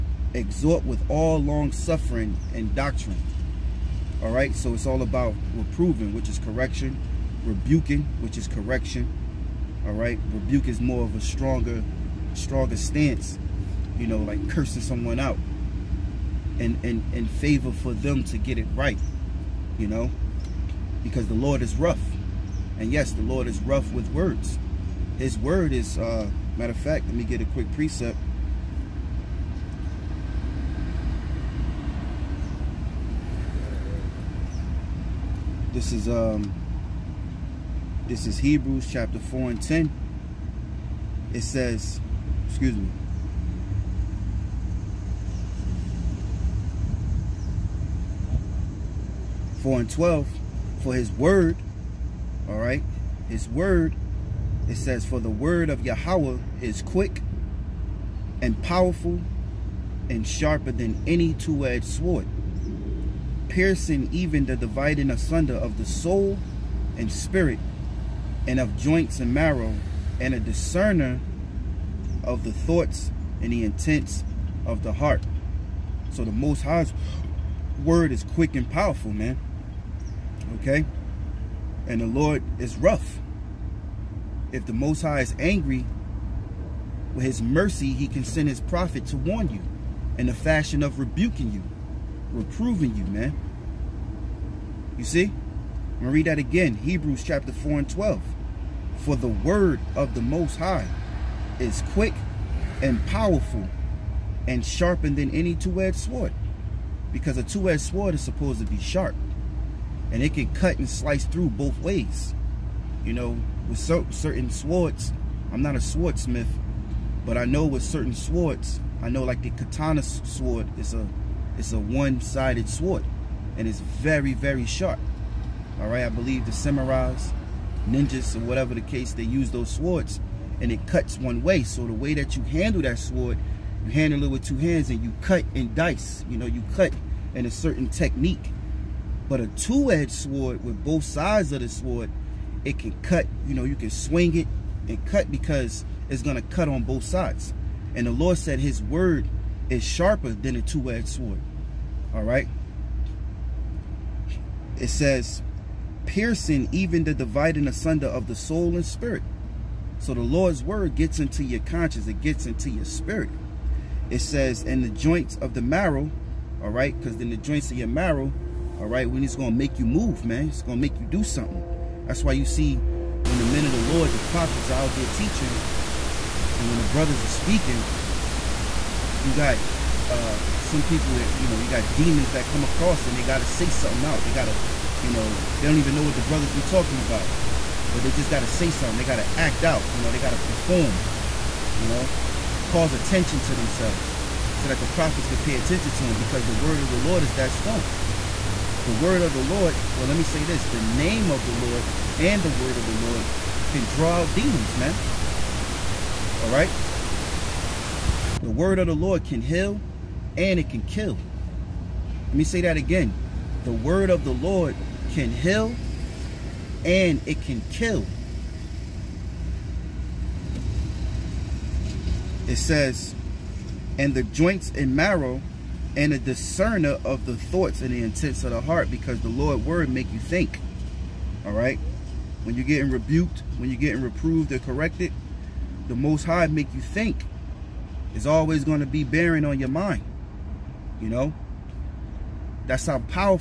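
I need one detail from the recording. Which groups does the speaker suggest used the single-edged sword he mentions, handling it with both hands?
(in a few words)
samurais, ninjas.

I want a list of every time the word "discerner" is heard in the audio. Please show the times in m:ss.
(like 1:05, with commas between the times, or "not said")
1:10, 3:46.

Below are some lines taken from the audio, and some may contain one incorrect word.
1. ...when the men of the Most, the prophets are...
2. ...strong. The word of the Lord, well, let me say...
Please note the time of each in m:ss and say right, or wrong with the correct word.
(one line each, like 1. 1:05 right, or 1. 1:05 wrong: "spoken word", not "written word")
1. 2:53 wrong: "Lord", not "Most"
2. 3:17 right.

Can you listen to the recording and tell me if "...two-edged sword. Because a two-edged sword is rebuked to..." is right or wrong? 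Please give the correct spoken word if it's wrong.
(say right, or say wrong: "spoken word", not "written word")
wrong: "supposed", not "rebuked".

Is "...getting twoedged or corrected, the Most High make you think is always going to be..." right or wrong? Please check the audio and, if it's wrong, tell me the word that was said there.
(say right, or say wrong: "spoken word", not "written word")
wrong: "reproved", not "twoedged".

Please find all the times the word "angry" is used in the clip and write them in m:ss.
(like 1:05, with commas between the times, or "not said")
1:25.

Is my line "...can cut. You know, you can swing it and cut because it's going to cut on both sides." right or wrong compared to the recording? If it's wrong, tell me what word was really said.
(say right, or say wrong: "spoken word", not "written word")
right.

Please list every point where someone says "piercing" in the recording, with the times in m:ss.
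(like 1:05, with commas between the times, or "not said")
1:03, 2:36.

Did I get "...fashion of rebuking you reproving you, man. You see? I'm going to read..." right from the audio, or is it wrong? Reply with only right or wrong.
right.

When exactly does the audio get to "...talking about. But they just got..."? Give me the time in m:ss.
3:06.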